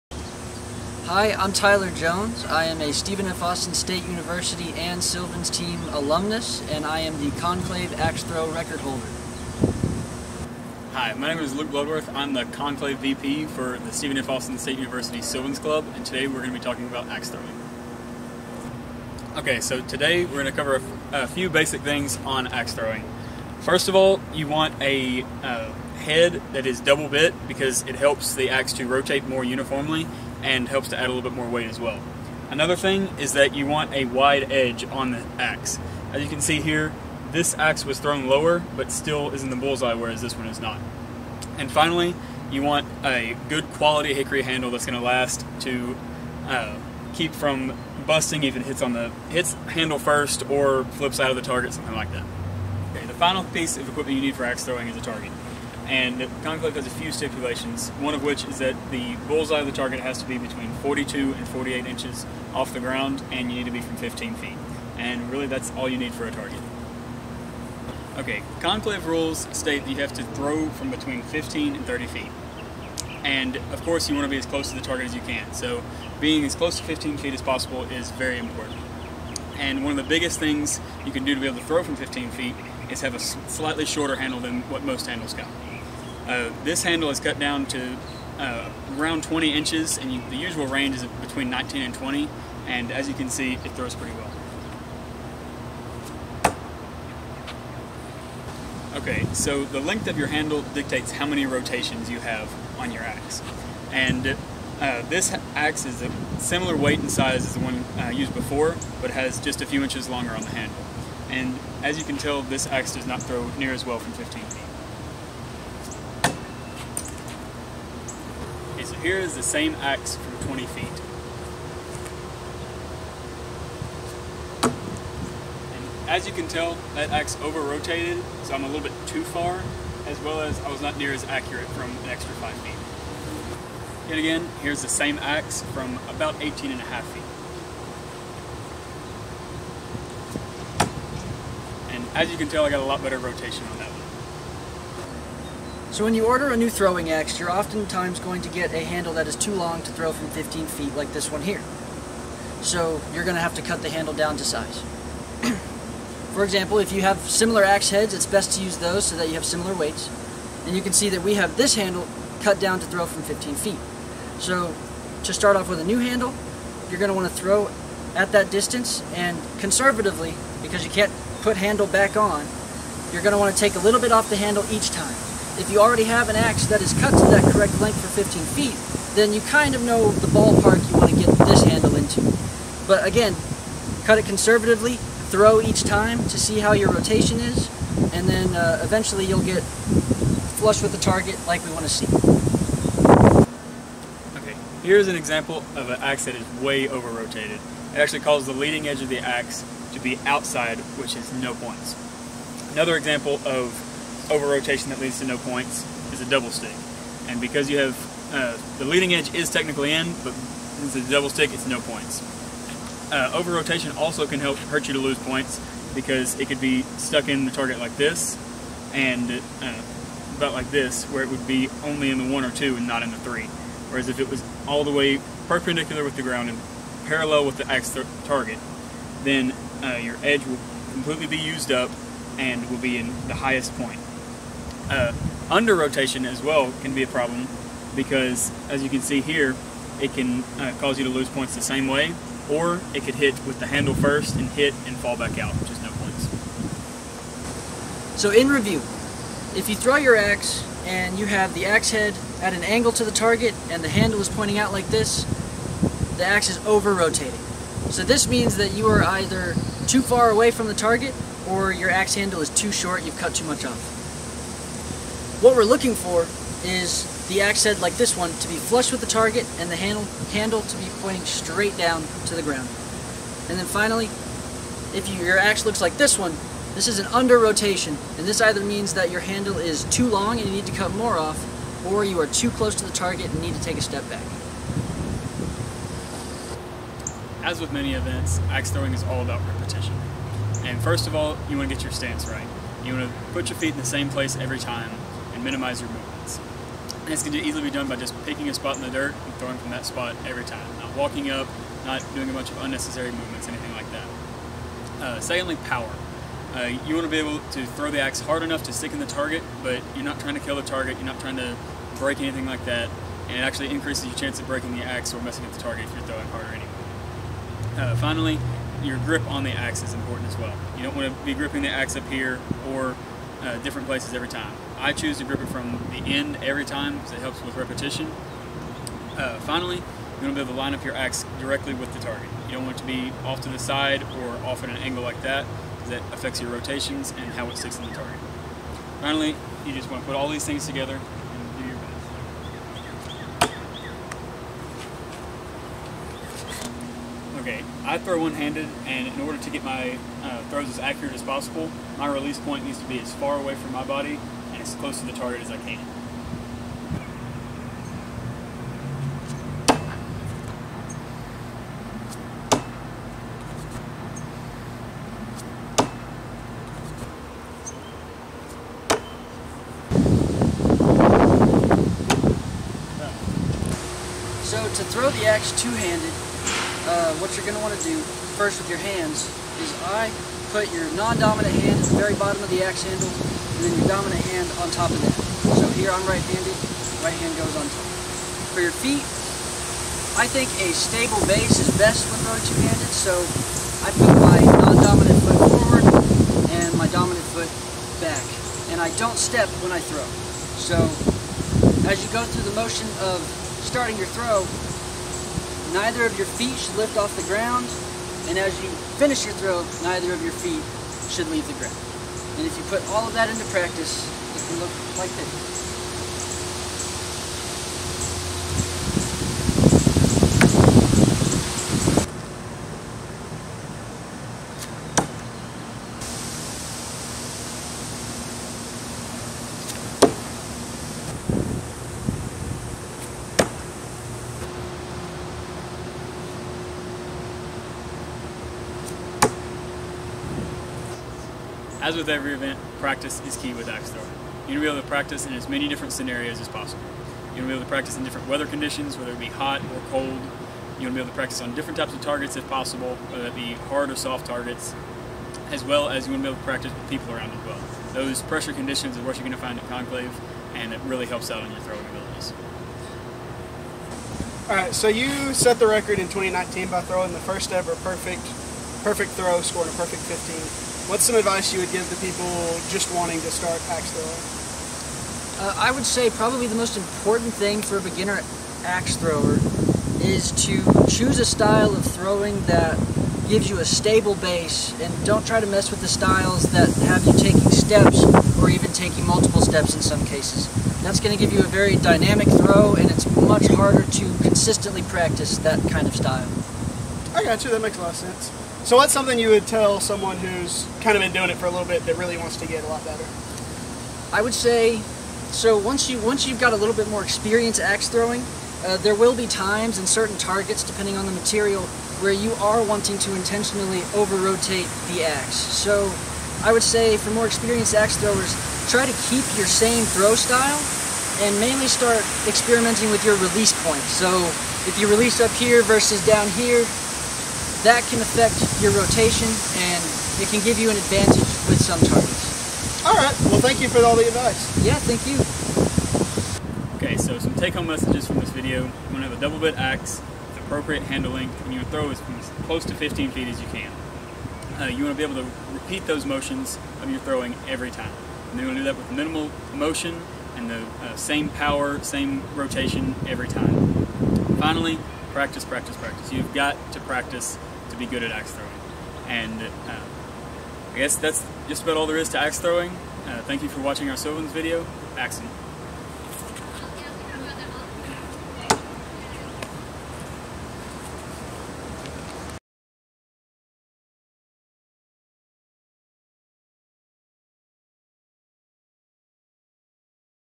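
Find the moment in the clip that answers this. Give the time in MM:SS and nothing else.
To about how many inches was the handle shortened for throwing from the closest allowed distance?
01:28.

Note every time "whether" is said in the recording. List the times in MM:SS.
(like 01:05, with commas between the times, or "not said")
07:28, 07:33.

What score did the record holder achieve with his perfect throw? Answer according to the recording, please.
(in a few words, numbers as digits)
15.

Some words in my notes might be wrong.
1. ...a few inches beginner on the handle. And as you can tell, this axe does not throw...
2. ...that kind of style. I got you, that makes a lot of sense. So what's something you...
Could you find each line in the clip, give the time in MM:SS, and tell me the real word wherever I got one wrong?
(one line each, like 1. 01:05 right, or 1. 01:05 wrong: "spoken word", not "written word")
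1. 01:49 wrong: "longer", not "beginner"
2. 08:15 right.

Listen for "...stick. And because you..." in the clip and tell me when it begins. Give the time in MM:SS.
03:26.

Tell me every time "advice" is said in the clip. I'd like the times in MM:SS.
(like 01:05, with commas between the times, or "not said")
07:51, 08:54.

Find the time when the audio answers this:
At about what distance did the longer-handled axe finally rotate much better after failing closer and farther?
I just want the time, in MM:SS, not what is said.
02:16.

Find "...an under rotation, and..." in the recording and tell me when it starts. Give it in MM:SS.
04:36.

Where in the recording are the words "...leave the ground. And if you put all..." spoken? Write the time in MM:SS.
06:51.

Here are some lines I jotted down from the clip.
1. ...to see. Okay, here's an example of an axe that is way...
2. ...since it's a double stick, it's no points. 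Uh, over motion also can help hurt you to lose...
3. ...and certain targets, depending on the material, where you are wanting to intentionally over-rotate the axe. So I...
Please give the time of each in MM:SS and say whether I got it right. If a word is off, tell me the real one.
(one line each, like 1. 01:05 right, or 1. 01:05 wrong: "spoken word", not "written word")
1. 03:11 right
2. 03:30 wrong: "rotation", not "motion"
3. 08:29 right.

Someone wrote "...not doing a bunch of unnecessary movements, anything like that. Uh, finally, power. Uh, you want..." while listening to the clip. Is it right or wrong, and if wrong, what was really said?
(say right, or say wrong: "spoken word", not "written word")
wrong: "secondly", not "finally".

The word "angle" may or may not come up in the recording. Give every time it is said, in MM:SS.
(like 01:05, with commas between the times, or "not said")
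04:12, 05:34.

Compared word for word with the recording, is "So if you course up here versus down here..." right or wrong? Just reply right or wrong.
wrong.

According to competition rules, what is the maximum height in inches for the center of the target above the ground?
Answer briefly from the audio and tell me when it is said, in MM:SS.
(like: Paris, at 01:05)
48, at 01:01.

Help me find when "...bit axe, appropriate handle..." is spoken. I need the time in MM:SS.
08:59.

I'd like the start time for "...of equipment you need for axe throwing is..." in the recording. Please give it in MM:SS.
00:53.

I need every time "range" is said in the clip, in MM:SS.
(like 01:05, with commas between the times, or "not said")
01:30.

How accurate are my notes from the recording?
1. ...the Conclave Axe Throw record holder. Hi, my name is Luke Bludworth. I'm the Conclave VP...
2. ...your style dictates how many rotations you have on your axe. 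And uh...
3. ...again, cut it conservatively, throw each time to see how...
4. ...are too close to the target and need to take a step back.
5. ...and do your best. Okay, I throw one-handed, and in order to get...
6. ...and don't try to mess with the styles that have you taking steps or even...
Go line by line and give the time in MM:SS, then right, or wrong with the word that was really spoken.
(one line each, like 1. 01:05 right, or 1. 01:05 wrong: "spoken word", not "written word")
1. 00:07 right
2. 01:40 wrong: "handle", not "style"
3. 03:03 right
4. 04:42 right
5. 05:40 right
6. 08:04 right.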